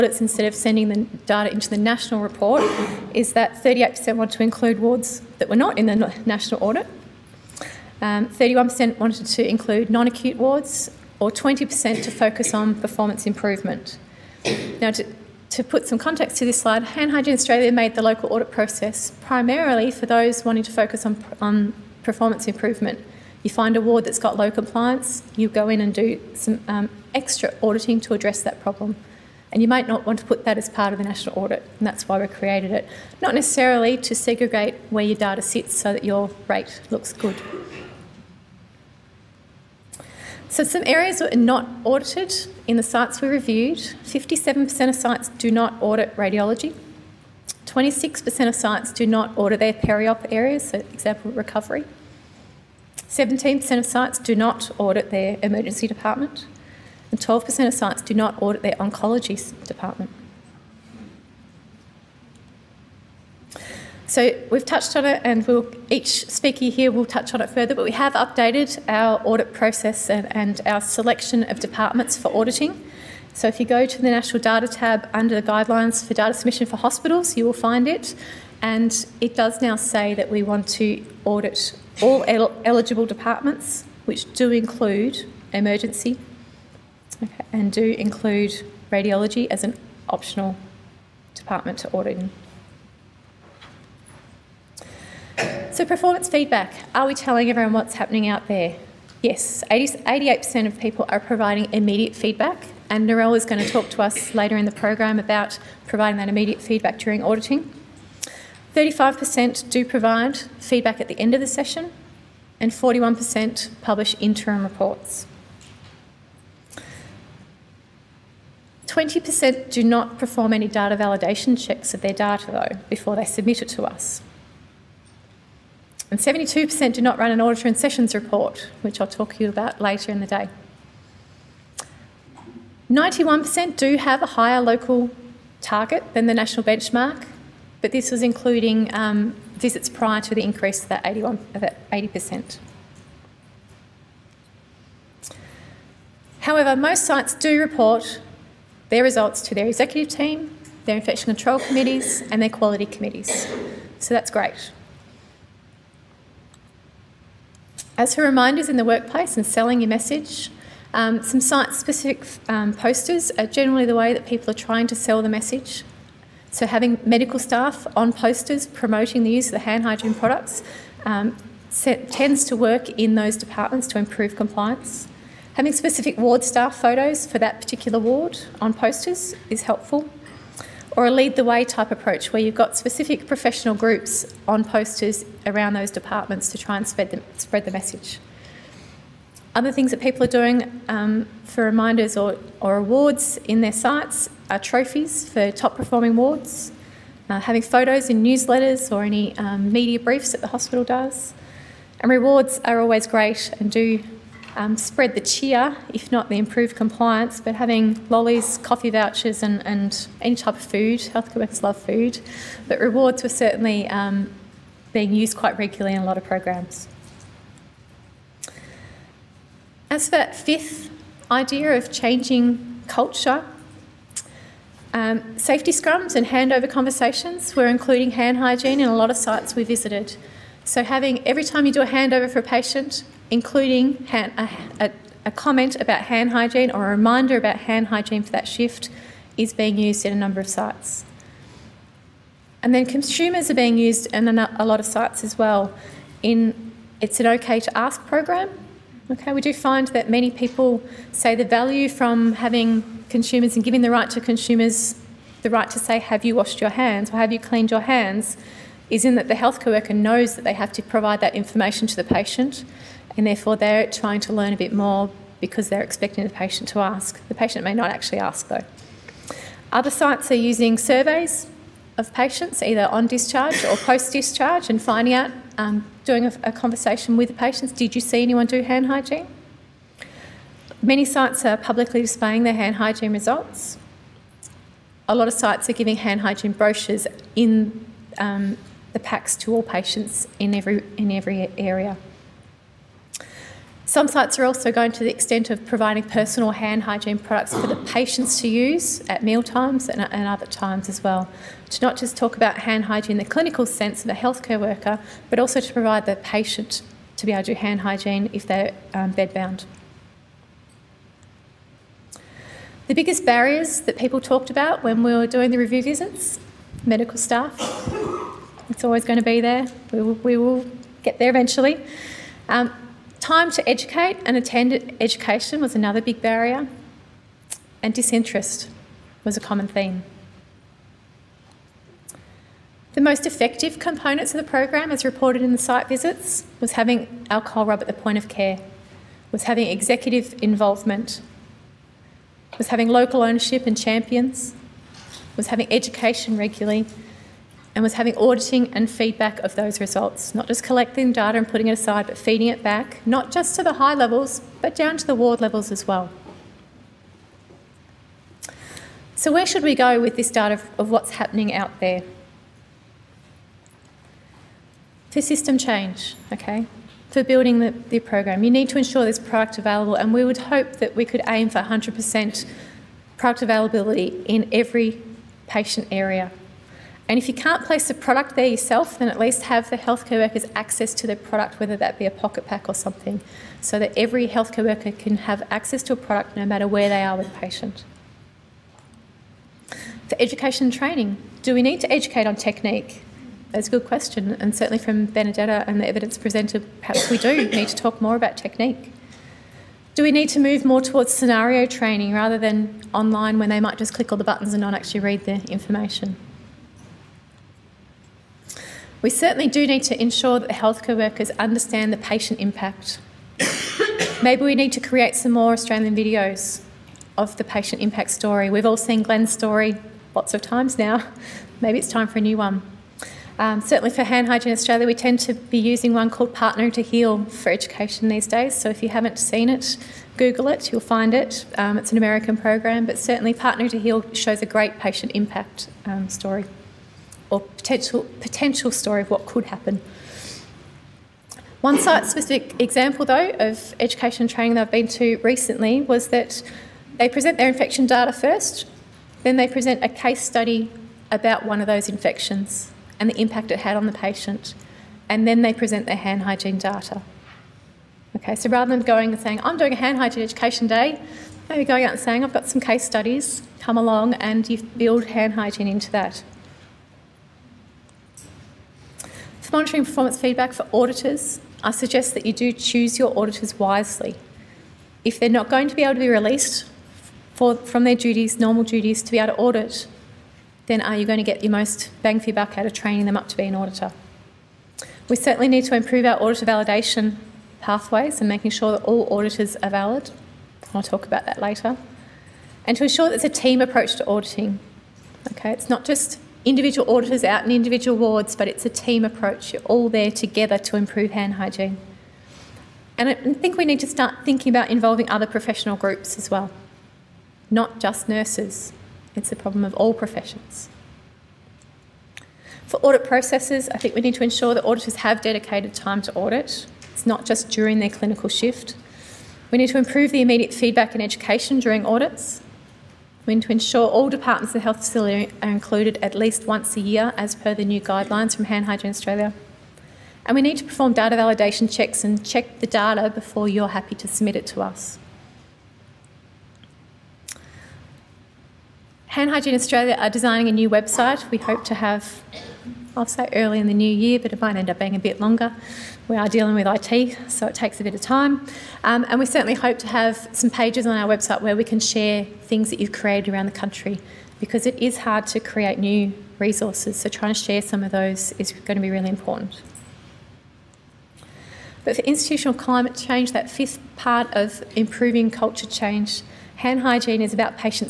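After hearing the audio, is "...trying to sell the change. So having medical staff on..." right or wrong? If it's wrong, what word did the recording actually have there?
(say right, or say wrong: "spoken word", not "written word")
wrong: "message", not "change".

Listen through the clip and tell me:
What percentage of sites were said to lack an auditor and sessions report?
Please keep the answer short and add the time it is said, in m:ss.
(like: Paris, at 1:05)
72%, at 2:06.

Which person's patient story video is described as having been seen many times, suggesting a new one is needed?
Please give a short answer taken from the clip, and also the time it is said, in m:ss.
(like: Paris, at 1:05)
Glenn, at 6:59.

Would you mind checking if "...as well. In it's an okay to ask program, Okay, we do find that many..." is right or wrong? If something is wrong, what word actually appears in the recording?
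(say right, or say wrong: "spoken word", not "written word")
right.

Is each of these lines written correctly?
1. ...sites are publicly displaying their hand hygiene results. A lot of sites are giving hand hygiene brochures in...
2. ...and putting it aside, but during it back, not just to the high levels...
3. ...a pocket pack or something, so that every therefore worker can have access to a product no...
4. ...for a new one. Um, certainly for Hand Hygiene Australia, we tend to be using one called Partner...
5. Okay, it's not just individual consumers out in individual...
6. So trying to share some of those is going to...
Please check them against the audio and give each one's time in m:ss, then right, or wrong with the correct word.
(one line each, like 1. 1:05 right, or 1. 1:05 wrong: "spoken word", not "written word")
1. 4:41 right
2. 5:51 wrong: "feeding", not "during"
3. 6:22 wrong: "healthcare", not "therefore"
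4. 7:02 right
5. 8:15 wrong: "auditors", not "consumers"
6. 9:16 right.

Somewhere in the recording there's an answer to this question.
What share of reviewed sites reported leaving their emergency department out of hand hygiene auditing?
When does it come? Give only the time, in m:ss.
0:53.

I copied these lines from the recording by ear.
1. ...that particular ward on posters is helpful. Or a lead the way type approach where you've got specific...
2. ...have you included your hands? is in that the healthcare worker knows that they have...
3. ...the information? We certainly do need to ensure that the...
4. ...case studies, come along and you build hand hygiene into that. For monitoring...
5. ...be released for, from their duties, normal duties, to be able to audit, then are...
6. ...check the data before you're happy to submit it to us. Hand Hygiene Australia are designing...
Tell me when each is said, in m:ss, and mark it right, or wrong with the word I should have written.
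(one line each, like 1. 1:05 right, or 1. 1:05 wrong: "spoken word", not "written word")
1. 2:57 right
2. 4:17 wrong: "cleaned", not "included"
3. 6:45 right
4. 7:42 right
5. 7:56 right
6. 8:52 right.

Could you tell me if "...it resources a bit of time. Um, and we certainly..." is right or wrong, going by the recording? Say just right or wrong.
wrong.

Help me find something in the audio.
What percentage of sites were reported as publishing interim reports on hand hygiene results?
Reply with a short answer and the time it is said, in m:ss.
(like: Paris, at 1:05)
41%, at 1:52.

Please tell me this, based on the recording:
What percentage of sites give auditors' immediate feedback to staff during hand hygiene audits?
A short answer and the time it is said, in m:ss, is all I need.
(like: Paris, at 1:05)
88%, at 1:39.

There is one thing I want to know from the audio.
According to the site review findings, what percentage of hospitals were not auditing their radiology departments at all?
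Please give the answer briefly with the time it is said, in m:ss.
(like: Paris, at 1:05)
57%, at 0:43.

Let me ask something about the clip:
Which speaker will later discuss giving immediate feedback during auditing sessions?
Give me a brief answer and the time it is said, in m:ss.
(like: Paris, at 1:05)
Narelle, at 1:43.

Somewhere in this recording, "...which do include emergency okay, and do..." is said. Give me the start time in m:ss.
1:24.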